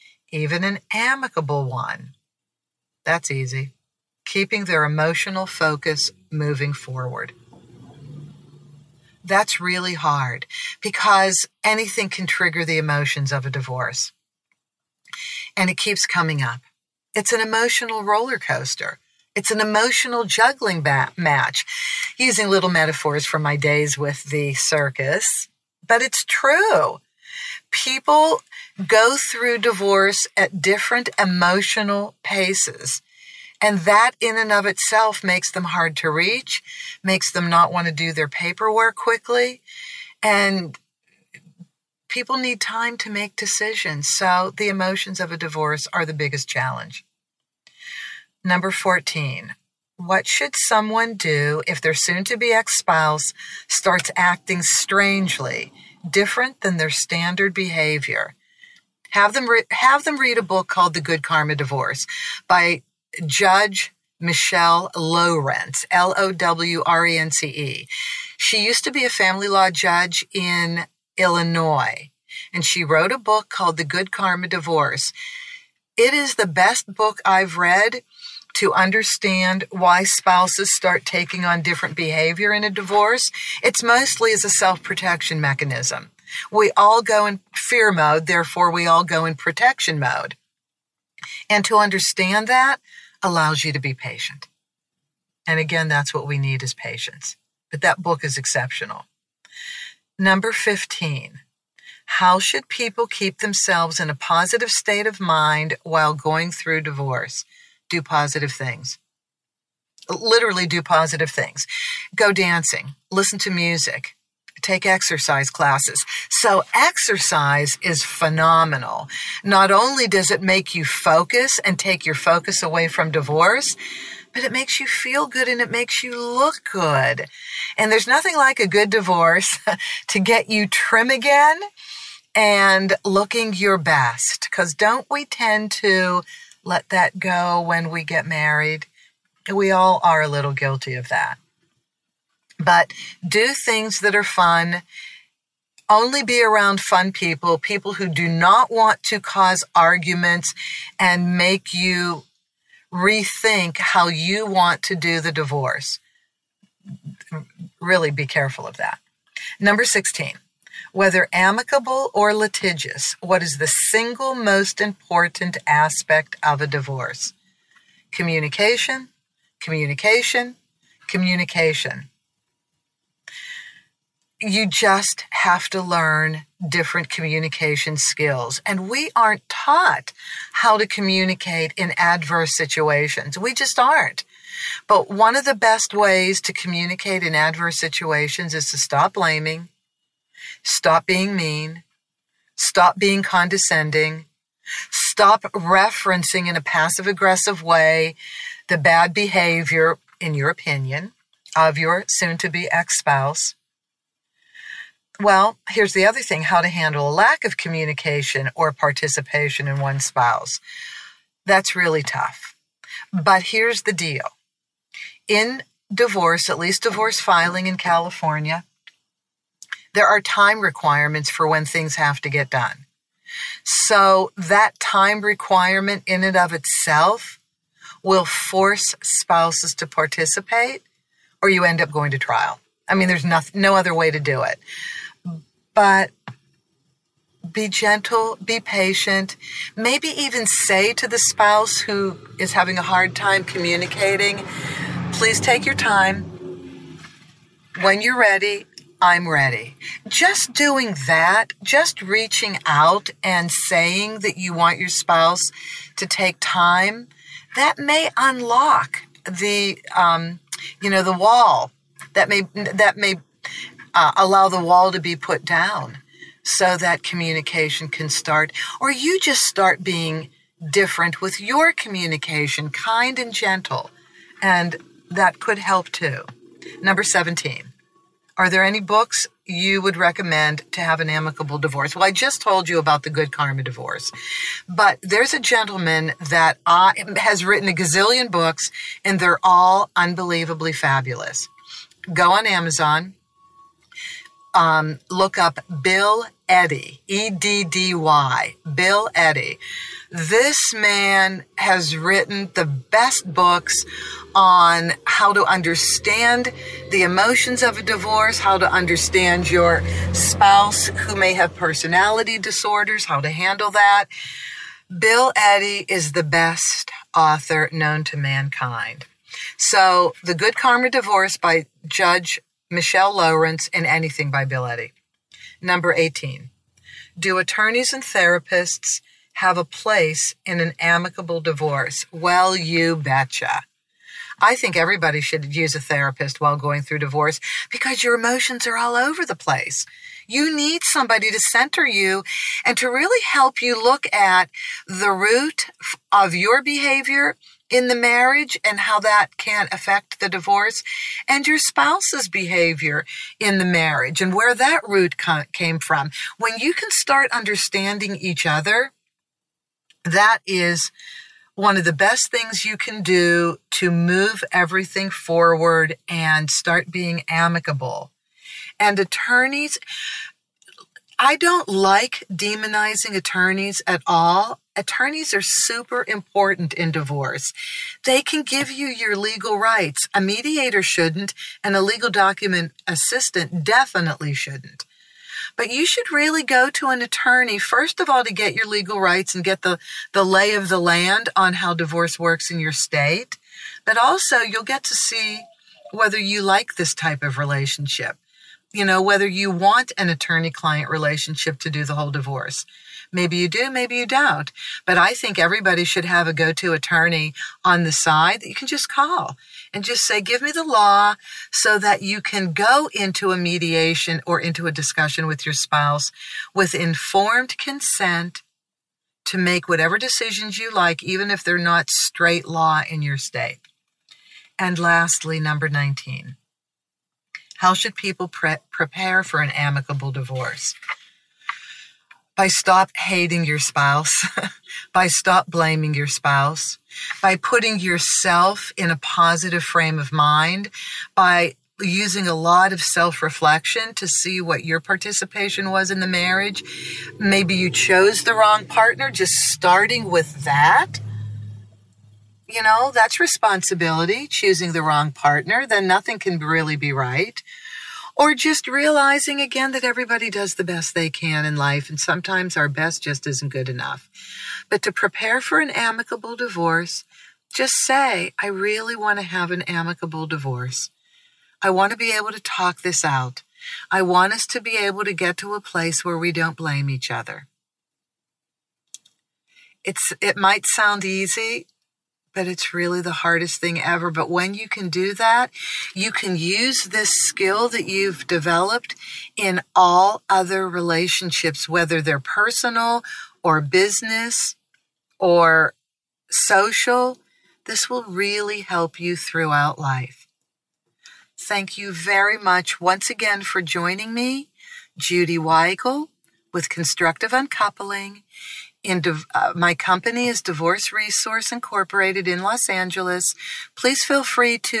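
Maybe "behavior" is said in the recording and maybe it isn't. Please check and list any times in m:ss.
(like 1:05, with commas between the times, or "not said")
0:57, 1:21, 3:19, 5:46, 5:52.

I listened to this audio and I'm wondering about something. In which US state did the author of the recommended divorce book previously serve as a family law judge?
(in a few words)
Illinois.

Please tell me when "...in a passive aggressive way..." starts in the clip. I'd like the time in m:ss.
3:16.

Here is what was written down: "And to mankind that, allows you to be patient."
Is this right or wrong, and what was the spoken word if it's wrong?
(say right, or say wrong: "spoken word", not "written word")
wrong: "understand", not "mankind".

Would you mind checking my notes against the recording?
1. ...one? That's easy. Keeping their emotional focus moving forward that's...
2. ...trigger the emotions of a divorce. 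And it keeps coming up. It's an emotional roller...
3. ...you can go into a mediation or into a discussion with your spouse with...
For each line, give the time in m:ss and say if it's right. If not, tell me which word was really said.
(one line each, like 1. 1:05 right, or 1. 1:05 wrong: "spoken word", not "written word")
1. 0:01 right
2. 0:12 right
3. 6:52 right.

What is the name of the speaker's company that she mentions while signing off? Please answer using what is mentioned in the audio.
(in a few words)
Divorce Resource Incorporated.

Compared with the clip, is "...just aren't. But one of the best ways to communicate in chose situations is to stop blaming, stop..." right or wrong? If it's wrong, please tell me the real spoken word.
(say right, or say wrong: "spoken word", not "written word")
wrong: "adverse", not "chose".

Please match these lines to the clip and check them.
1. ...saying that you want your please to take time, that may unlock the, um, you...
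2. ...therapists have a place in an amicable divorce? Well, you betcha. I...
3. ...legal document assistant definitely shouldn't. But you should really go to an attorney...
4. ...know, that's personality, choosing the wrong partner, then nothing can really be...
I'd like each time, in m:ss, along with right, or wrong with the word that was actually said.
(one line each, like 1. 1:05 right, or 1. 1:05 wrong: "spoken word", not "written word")
1. 4:13 wrong: "spouse", not "please"
2. 5:28 right
3. 6:21 right
4. 7:32 wrong: "responsibility", not "personality".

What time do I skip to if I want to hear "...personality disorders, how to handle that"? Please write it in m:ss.
5:11.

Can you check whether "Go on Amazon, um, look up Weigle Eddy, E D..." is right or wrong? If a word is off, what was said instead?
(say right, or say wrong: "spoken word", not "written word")
wrong: "Bill", not "Weigle".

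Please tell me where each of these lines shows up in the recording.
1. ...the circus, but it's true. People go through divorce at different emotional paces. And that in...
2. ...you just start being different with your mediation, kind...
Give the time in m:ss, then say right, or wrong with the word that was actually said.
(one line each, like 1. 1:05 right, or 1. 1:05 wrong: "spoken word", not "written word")
1. 0:24 right
2. 4:28 wrong: "communication", not "mediation".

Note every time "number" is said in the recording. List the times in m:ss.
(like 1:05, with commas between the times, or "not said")
0:48, 1:40, 2:39, 4:36, 5:25, 7:05.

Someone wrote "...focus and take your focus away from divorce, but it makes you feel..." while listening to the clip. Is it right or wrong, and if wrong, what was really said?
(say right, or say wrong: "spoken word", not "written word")
right.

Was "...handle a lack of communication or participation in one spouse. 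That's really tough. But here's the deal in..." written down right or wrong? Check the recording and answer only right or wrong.
right.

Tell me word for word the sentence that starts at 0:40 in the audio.
And people need time to make decisions.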